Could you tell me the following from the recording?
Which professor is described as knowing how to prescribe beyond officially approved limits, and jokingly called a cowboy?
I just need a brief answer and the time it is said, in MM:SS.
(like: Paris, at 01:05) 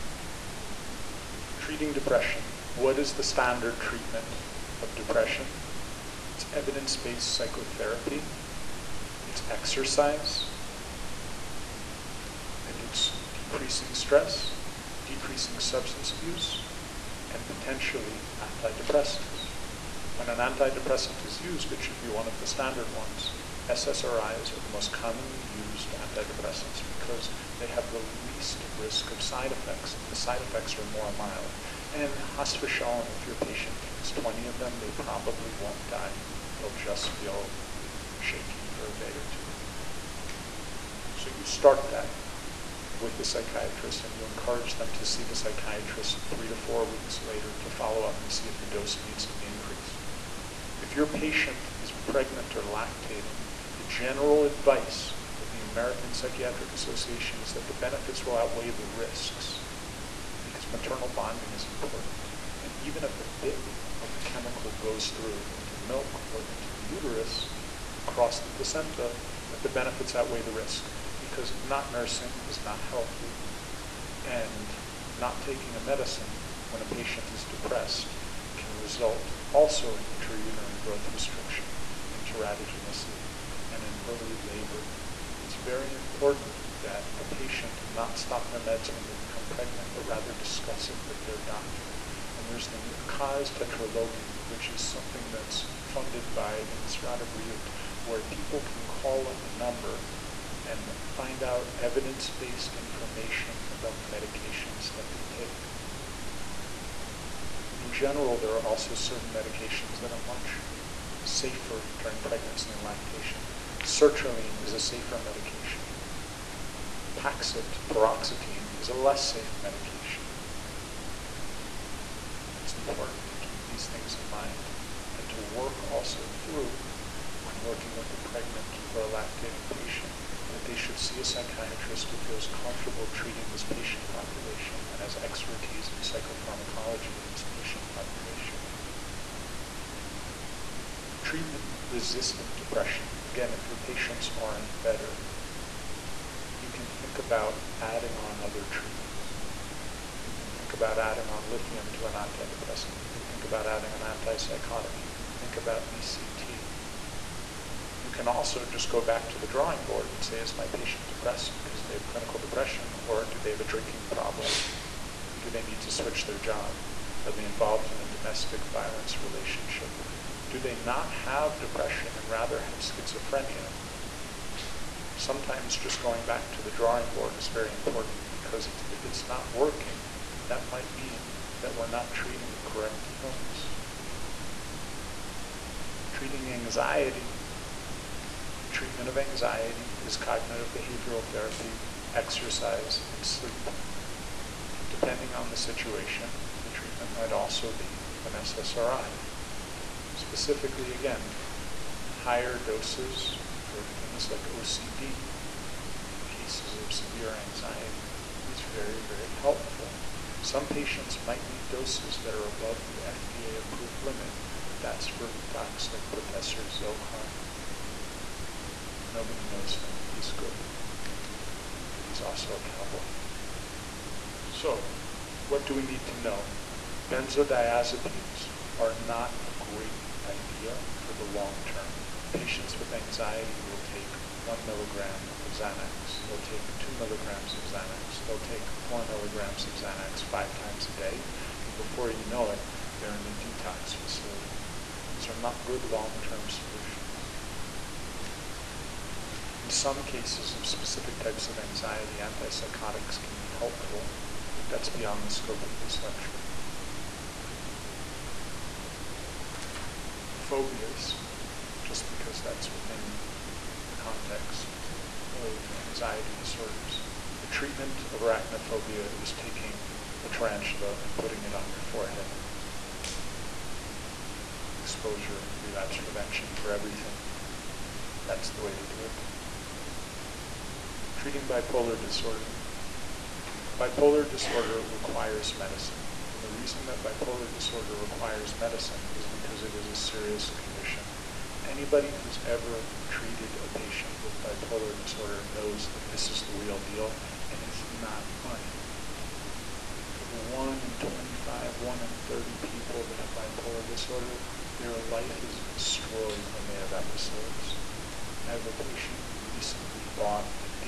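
Professor Zohar, at 03:36.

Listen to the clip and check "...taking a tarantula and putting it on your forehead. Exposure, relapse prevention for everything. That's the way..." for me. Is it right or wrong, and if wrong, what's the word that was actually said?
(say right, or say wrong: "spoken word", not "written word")
right.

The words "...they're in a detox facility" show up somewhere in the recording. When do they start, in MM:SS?
04:03.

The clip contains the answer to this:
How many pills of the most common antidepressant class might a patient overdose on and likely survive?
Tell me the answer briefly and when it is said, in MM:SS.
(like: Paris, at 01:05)
20, at 00:34.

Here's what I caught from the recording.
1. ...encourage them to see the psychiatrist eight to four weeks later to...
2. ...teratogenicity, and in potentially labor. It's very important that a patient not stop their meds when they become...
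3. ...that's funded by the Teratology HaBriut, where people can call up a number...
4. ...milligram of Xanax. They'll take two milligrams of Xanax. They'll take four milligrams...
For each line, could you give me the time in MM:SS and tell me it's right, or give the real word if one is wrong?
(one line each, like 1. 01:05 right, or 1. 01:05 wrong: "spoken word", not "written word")
1. 00:44 wrong: "three", not "eight"
2. 01:22 wrong: "early", not "potentially"
3. 01:35 wrong: "Misrad", not "Teratology"
4. 03:54 right.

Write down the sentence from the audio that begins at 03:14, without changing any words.
Depending on the situation, the treatment might also be an SSRI.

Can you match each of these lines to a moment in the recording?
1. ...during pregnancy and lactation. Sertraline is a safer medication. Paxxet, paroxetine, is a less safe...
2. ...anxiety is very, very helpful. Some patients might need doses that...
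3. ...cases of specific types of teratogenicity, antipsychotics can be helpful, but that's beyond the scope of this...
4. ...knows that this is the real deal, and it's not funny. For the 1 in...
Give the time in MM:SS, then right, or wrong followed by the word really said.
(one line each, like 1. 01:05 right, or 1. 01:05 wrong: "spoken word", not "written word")
1. 01:51 right
2. 03:27 right
3. 04:10 wrong: "anxiety", not "teratogenicity"
4. 04:55 right.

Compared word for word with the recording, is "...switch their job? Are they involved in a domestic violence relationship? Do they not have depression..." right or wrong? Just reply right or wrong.
right.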